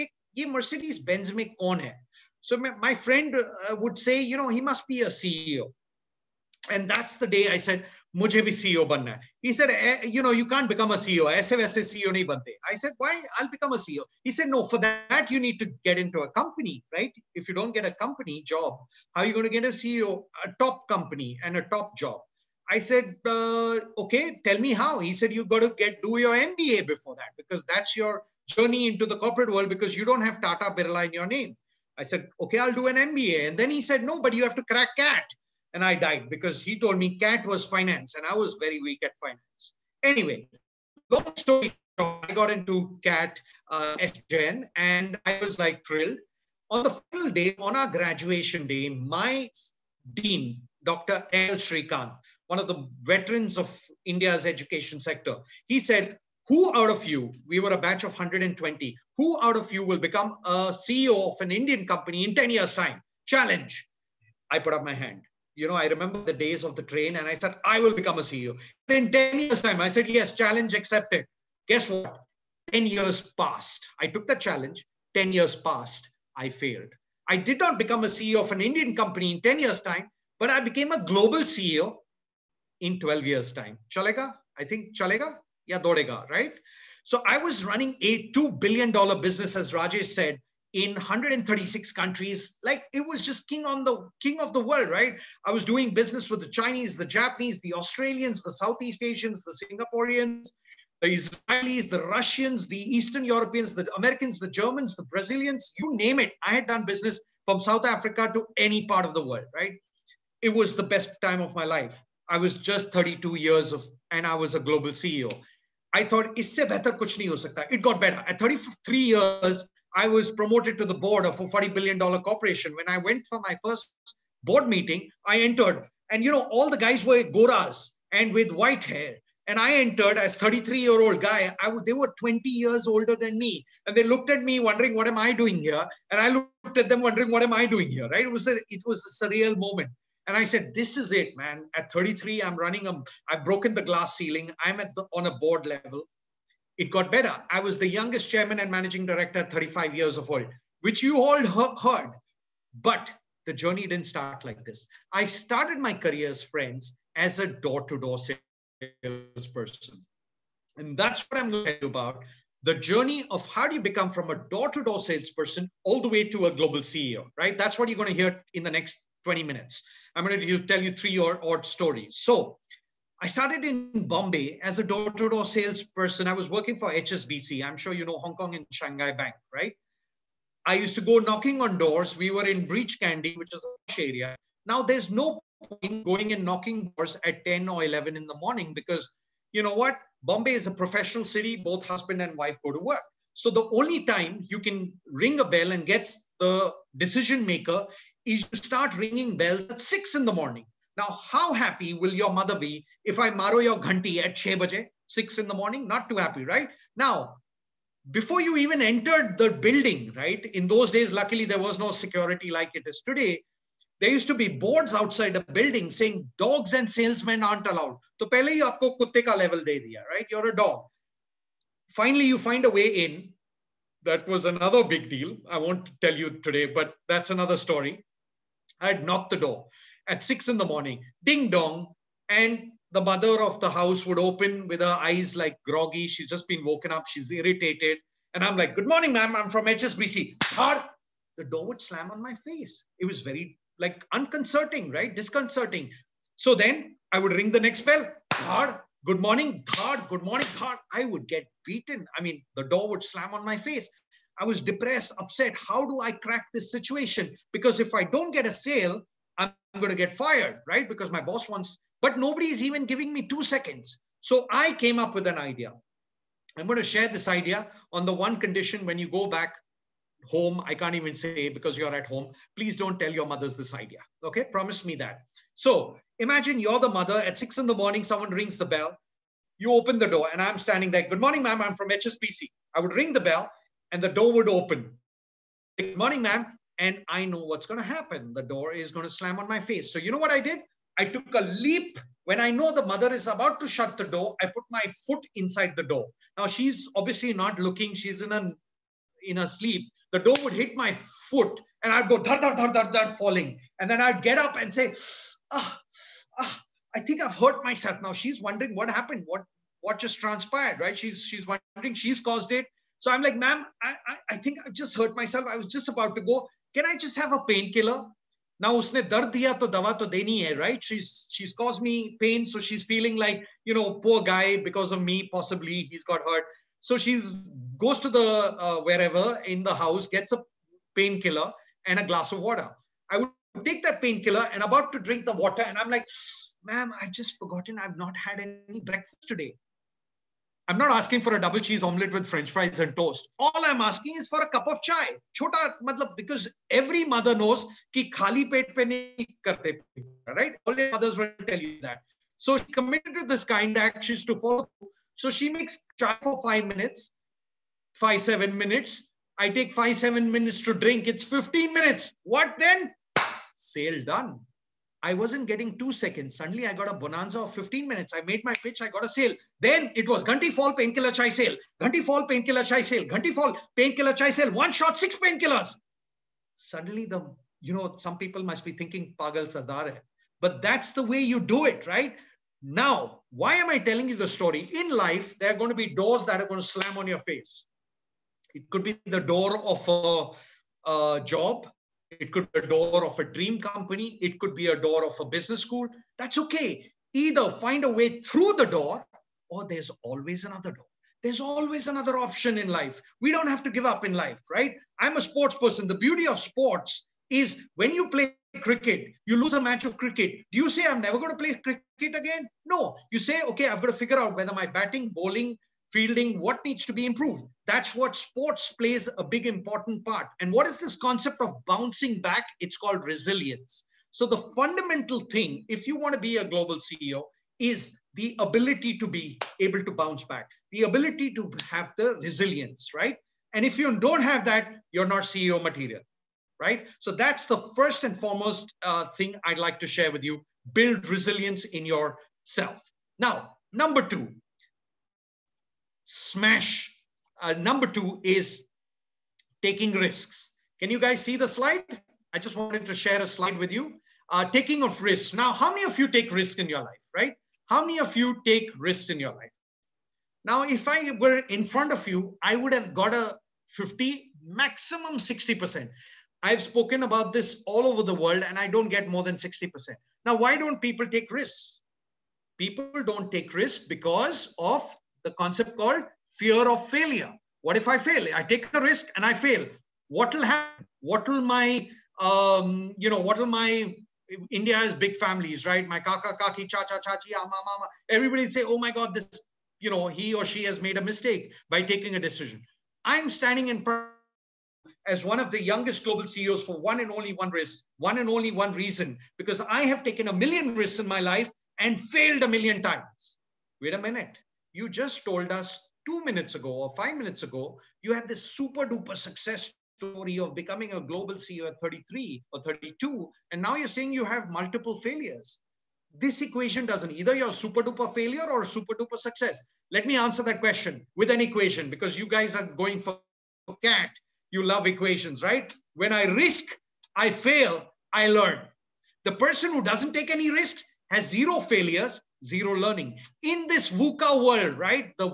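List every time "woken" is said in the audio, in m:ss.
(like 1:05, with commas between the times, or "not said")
3:56.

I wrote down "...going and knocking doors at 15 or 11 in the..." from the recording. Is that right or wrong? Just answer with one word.
wrong.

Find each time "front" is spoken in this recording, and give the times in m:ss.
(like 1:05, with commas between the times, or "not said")
7:41, 8:13.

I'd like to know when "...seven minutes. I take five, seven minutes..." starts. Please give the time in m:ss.
5:58.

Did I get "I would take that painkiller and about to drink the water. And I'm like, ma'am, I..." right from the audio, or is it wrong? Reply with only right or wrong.
right.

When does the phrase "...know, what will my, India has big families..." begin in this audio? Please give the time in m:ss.
8:03.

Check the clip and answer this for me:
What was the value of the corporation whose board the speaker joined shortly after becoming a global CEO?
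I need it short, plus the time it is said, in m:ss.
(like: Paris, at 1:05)
$40 billion, at 2:01.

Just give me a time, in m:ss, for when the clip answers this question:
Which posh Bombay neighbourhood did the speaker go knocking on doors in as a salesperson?
3:02.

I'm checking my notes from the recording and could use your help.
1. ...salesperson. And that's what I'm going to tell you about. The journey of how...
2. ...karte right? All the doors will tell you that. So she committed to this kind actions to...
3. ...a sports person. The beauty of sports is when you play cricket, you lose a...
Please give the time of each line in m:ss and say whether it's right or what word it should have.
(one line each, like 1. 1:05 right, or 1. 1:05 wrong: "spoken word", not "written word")
1. 2:39 right
2. 5:49 wrong: "mothers", not "doors"
3. 6:45 right.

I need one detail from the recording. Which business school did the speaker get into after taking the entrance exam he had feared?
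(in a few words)
SP Jain.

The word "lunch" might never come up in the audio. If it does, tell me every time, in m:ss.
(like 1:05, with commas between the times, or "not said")
not said.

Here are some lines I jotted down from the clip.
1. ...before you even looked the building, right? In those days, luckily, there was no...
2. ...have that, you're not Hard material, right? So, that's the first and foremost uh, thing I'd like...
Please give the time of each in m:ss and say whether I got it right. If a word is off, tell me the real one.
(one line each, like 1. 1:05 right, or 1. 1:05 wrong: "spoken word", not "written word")
1. 3:28 wrong: "entered", not "looked"
2. 7:14 wrong: "CEO", not "Hard".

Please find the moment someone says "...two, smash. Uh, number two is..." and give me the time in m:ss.
7:24.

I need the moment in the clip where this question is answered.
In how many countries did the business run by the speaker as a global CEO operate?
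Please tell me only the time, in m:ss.
1:30.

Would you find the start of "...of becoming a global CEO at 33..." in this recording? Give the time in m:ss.
8:30.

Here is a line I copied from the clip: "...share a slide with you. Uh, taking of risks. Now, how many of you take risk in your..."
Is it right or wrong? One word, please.
right.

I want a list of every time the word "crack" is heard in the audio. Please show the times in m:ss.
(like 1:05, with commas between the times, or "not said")
0:34, 4:16.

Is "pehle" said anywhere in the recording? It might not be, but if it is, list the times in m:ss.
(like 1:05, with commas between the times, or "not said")
3:38.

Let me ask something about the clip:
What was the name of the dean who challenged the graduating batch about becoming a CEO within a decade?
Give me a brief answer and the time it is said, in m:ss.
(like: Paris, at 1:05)
Dr. L. 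Srikant, at 0:50.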